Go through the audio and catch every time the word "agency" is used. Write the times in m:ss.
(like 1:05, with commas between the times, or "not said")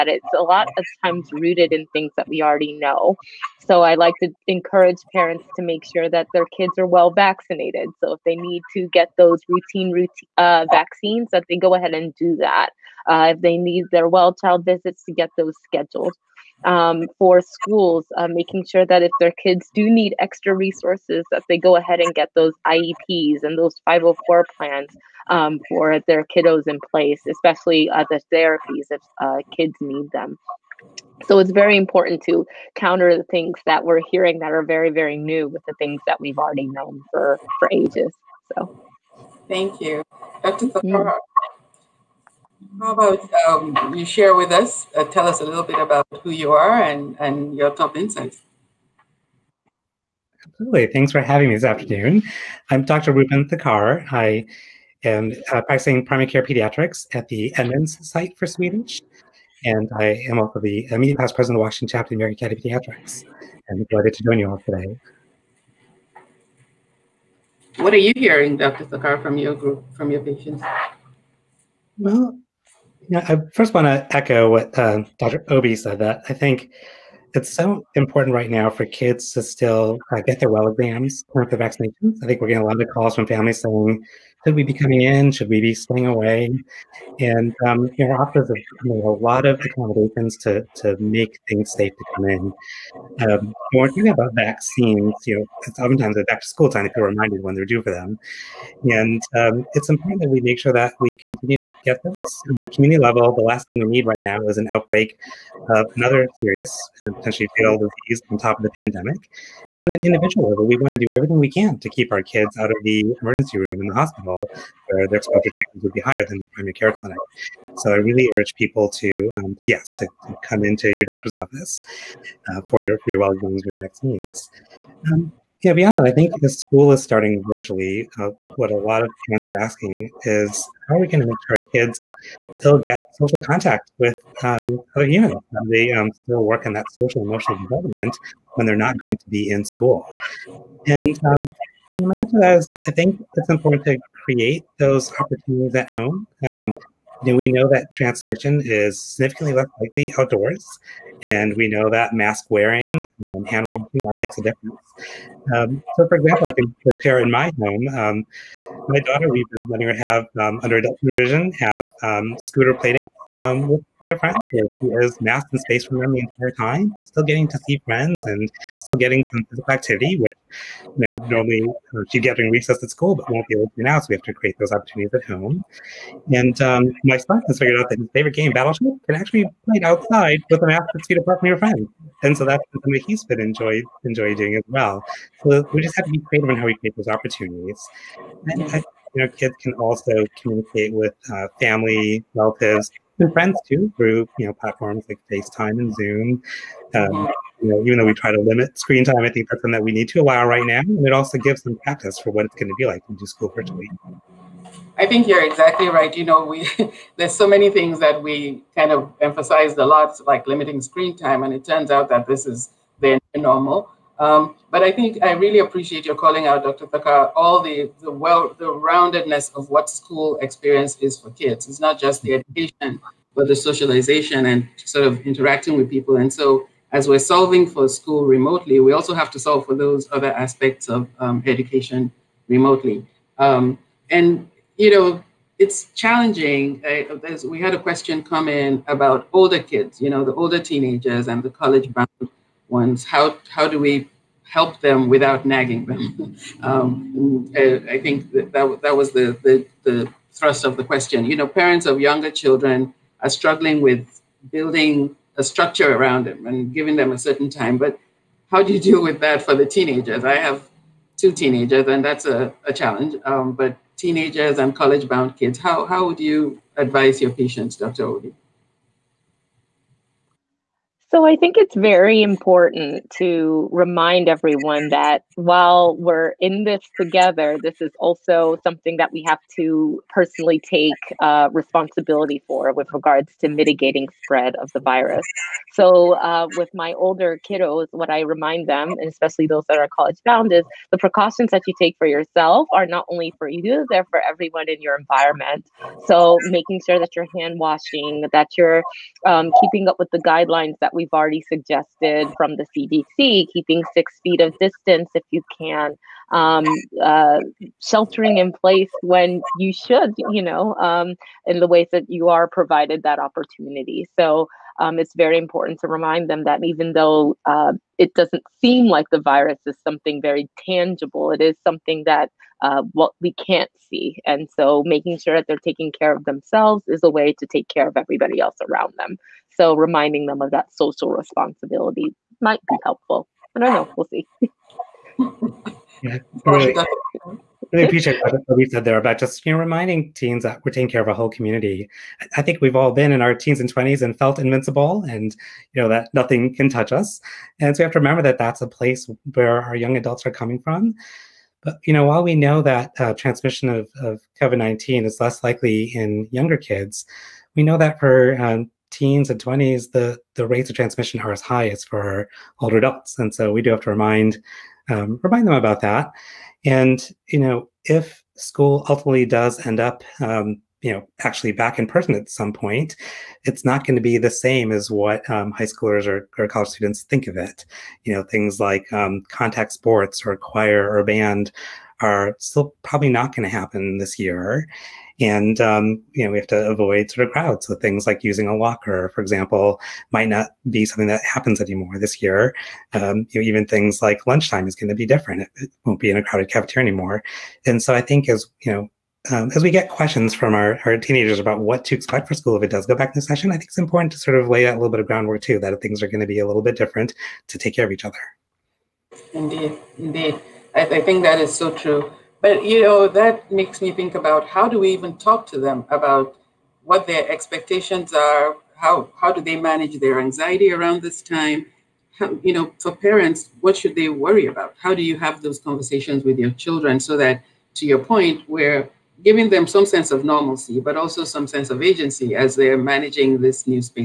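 7:11.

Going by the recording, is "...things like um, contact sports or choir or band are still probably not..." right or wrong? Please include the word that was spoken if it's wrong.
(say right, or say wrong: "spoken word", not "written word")
right.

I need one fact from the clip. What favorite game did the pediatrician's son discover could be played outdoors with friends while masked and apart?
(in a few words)
Battleship.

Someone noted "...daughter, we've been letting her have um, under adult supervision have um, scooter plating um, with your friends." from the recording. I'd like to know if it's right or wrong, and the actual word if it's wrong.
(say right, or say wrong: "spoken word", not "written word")
right.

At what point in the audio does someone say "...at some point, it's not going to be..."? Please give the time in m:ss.
6:12.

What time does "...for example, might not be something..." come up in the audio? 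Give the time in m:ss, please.
6:29.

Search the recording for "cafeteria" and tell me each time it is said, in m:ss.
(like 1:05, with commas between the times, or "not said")
6:36.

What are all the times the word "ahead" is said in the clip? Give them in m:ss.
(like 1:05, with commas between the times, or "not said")
0:11, 0:21.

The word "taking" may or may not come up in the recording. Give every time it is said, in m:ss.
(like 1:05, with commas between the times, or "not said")
5:25, 5:40.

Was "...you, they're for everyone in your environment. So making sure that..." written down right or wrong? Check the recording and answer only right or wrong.
right.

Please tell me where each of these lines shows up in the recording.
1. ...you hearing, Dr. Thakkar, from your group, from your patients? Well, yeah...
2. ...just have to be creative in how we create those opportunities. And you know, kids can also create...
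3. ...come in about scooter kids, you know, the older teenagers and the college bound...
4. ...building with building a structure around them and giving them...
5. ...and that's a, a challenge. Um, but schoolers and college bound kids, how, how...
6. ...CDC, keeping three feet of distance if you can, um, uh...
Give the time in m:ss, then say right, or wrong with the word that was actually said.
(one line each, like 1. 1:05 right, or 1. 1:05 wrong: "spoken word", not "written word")
1. 1:07 right
2. 3:05 wrong: "communicate", not "create"
3. 3:58 wrong: "older", not "scooter"
4. 4:13 wrong: "struggling", not "building"
5. 4:21 wrong: "teenagers", not "schoolers"
6. 5:02 wrong: "six", not "three".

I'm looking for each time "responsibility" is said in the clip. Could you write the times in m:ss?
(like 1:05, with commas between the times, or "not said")
4:41, 5:31.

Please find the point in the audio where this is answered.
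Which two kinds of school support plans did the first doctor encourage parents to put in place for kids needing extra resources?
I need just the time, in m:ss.
0:22.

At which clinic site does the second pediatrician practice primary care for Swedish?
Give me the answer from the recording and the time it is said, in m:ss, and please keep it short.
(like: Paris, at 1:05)
Edmonds, at 0:57.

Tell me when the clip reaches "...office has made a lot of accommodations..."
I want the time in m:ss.
1:28.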